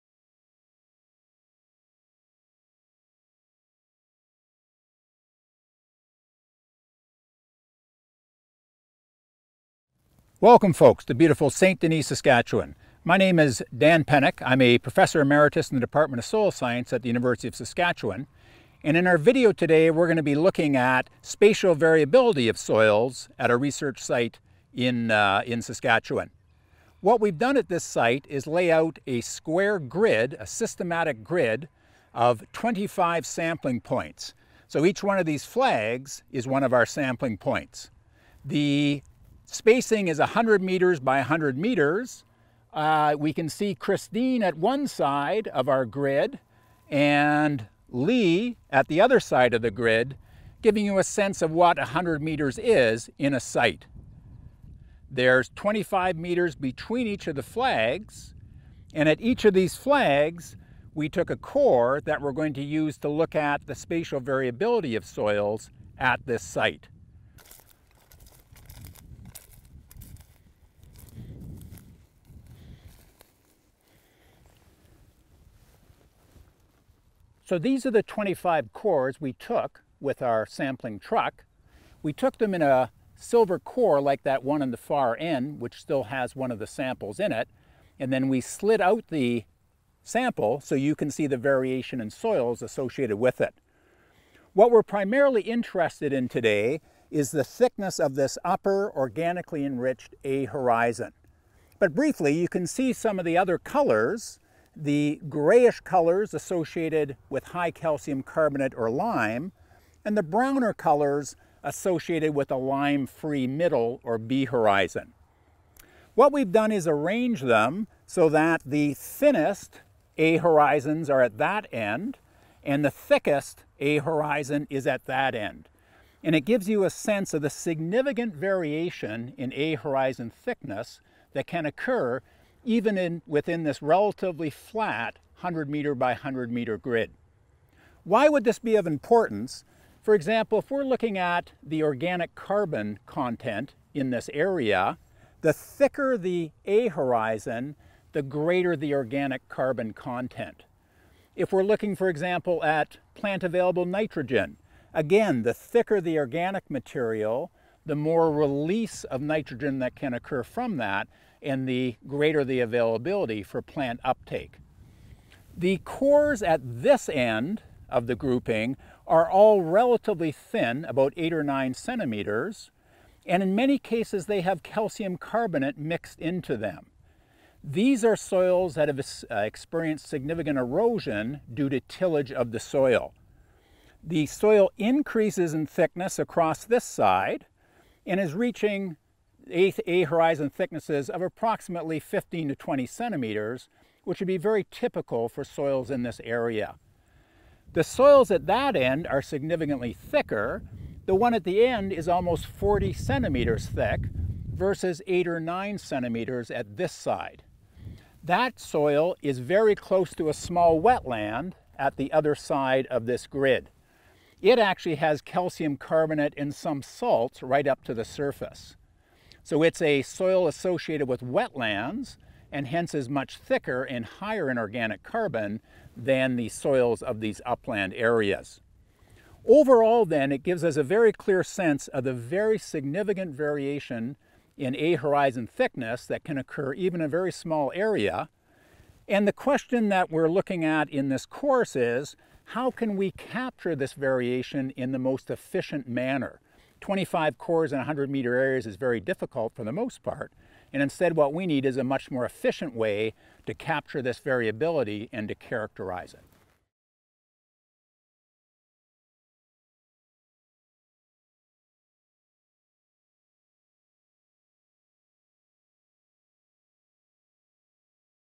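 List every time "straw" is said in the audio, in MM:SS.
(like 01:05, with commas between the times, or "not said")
not said.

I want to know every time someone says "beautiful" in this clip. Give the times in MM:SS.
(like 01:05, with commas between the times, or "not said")
00:11.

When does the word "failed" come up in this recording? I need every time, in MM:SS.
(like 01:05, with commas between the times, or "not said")
not said.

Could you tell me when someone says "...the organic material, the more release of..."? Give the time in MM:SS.
02:36.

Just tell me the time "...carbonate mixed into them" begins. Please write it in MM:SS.
02:55.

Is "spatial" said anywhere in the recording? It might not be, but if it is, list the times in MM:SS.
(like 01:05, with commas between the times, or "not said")
00:21, 01:03.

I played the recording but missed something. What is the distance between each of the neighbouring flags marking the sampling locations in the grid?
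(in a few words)
25 meters.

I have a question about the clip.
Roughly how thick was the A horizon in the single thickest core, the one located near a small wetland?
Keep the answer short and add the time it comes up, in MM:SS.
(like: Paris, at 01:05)
almost 40 centimeters, at 03:22.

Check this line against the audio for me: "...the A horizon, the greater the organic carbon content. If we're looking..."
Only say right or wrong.
right.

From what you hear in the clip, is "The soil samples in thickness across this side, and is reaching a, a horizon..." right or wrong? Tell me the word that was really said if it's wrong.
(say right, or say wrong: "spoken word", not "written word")
wrong: "increases", not "samples".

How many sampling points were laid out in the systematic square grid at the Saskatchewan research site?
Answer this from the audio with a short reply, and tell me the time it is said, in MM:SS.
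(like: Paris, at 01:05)
25, at 00:32.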